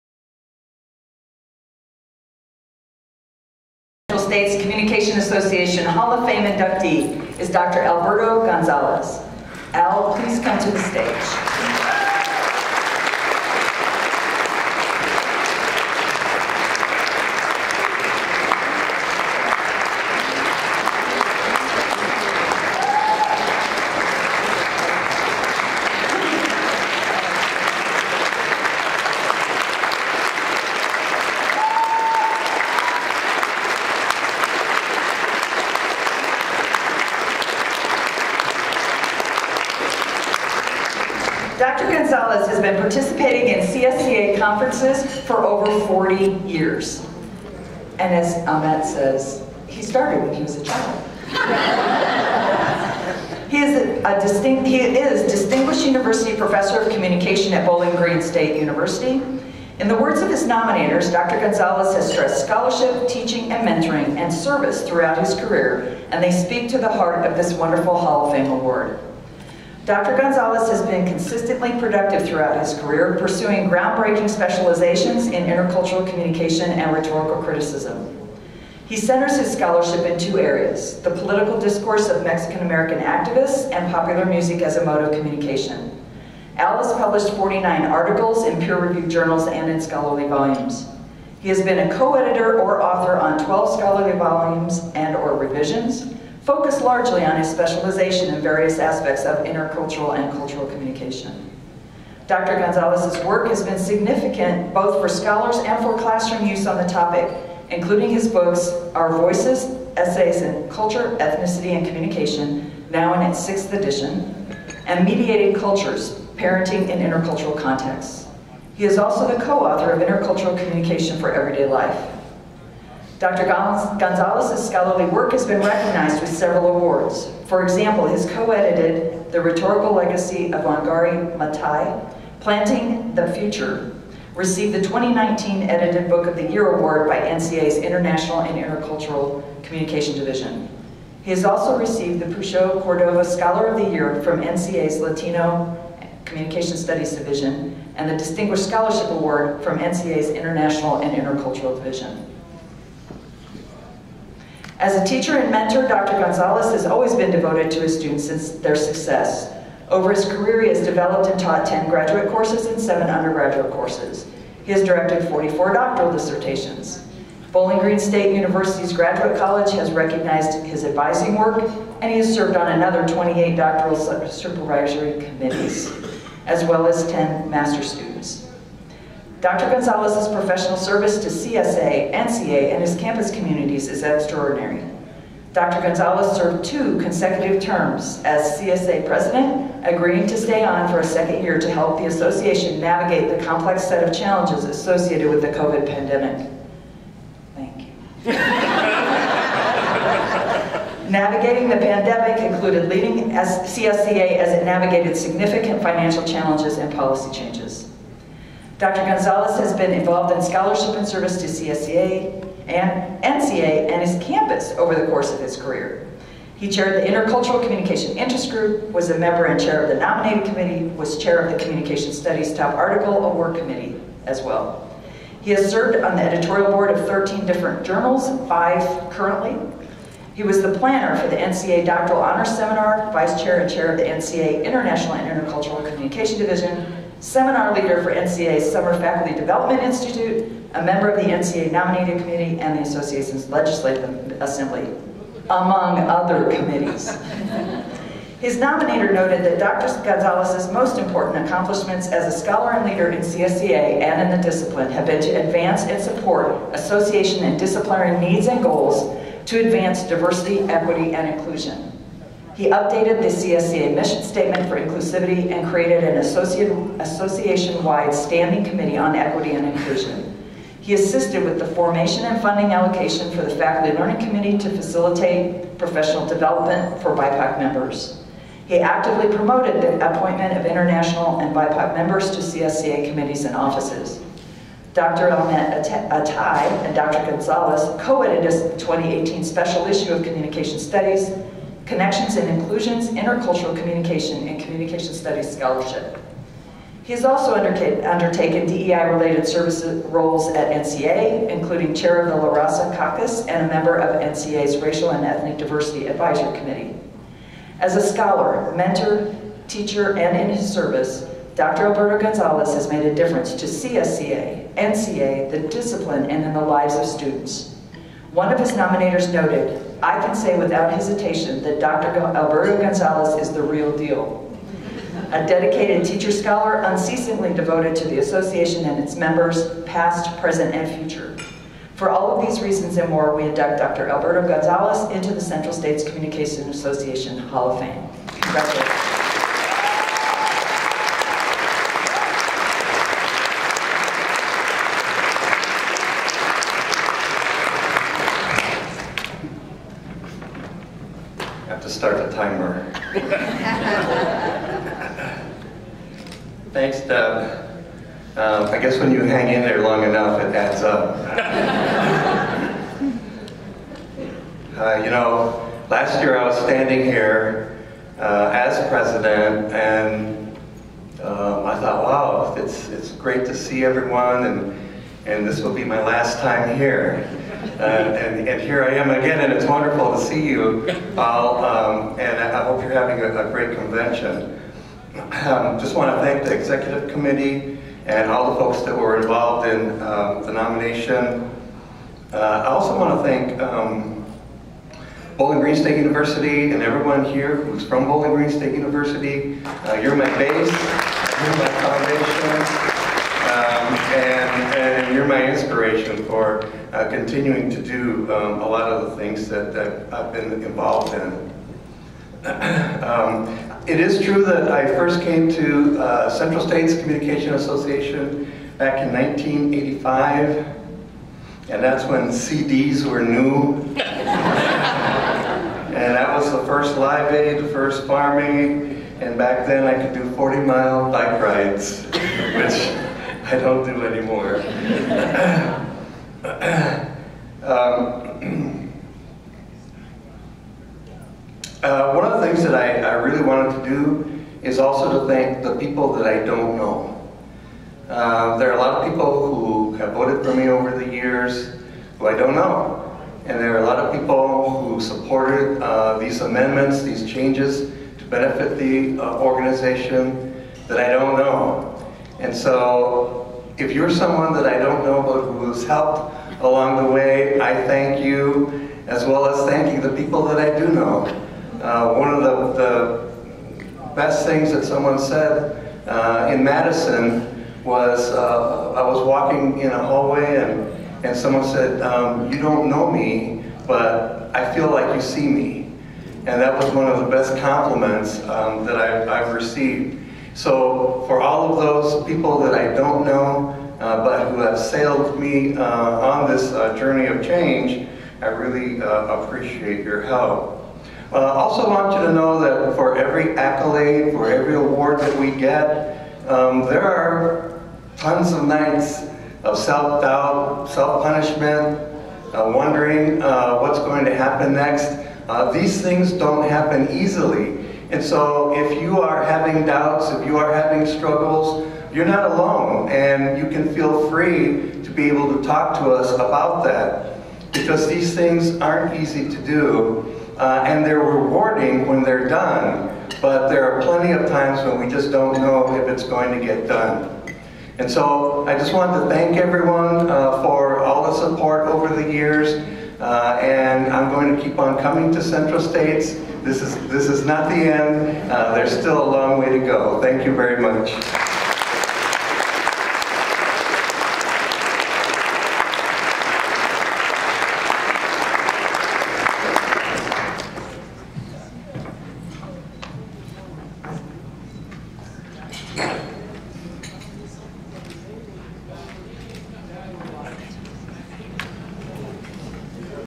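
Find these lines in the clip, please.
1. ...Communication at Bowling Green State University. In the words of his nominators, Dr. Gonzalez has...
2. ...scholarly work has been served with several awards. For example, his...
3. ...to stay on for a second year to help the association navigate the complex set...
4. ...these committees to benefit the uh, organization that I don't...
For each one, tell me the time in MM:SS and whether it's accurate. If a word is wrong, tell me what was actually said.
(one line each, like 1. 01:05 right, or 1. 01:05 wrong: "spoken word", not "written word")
1. 00:56 right
2. 02:04 wrong: "recognized", not "served"
3. 03:10 right
4. 07:37 wrong: "changes", not "committees".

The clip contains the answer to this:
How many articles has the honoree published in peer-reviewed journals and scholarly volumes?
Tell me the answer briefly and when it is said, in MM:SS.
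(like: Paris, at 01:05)
49, at 01:27.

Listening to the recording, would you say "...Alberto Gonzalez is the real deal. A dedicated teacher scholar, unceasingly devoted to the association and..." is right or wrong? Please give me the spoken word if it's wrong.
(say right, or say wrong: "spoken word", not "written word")
right.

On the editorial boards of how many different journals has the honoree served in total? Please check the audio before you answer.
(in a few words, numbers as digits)
13.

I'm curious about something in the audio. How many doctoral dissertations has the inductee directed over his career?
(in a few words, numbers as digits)
44.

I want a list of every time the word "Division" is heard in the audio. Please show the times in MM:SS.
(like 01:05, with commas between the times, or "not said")
02:20, 02:27, 02:31, 03:56.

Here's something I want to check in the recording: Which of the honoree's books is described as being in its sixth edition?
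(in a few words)
Our Voices.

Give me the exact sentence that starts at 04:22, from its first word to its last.
He updated the CSCA mission statement for inclusivity and created an association-wide standing committee on equity and inclusion.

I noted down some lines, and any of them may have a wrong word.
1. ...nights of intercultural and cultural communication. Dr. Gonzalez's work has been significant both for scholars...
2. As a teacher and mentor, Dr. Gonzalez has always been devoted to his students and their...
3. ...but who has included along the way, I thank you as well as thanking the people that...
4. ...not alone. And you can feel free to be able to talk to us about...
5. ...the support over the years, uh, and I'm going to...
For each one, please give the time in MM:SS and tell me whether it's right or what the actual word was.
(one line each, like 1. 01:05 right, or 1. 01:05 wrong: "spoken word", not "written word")
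1. 01:38 wrong: "aspects", not "nights"
2. 02:34 right
3. 07:45 wrong: "helped", not "included"
4. 08:42 right
5. 09:01 right.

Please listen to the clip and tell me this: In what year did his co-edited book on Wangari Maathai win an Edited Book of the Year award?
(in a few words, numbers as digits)
2019.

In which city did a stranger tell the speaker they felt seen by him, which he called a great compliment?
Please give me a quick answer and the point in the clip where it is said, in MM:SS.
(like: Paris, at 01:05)
Madison, at 07:56.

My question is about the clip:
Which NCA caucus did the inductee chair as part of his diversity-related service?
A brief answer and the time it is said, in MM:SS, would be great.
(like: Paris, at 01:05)
La Raza Caucus, at 05:02.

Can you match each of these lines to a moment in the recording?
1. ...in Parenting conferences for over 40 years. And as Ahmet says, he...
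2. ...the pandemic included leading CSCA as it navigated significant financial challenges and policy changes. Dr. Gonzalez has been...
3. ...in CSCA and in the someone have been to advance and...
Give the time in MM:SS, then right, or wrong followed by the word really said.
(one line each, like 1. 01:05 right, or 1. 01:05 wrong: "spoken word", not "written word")
1. 00:43 wrong: "CSCA", not "Parenting"
2. 03:21 right
3. 04:13 wrong: "discipline", not "someone".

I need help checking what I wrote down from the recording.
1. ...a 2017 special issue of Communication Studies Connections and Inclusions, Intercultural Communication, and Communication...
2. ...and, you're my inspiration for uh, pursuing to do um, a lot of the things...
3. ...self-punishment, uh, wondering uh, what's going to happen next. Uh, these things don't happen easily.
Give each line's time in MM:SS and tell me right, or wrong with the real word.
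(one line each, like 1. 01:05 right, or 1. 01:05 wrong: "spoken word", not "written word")
1. 04:48 wrong: "2018", not "2017"
2. 06:44 wrong: "continuing", not "pursuing"
3. 08:30 right.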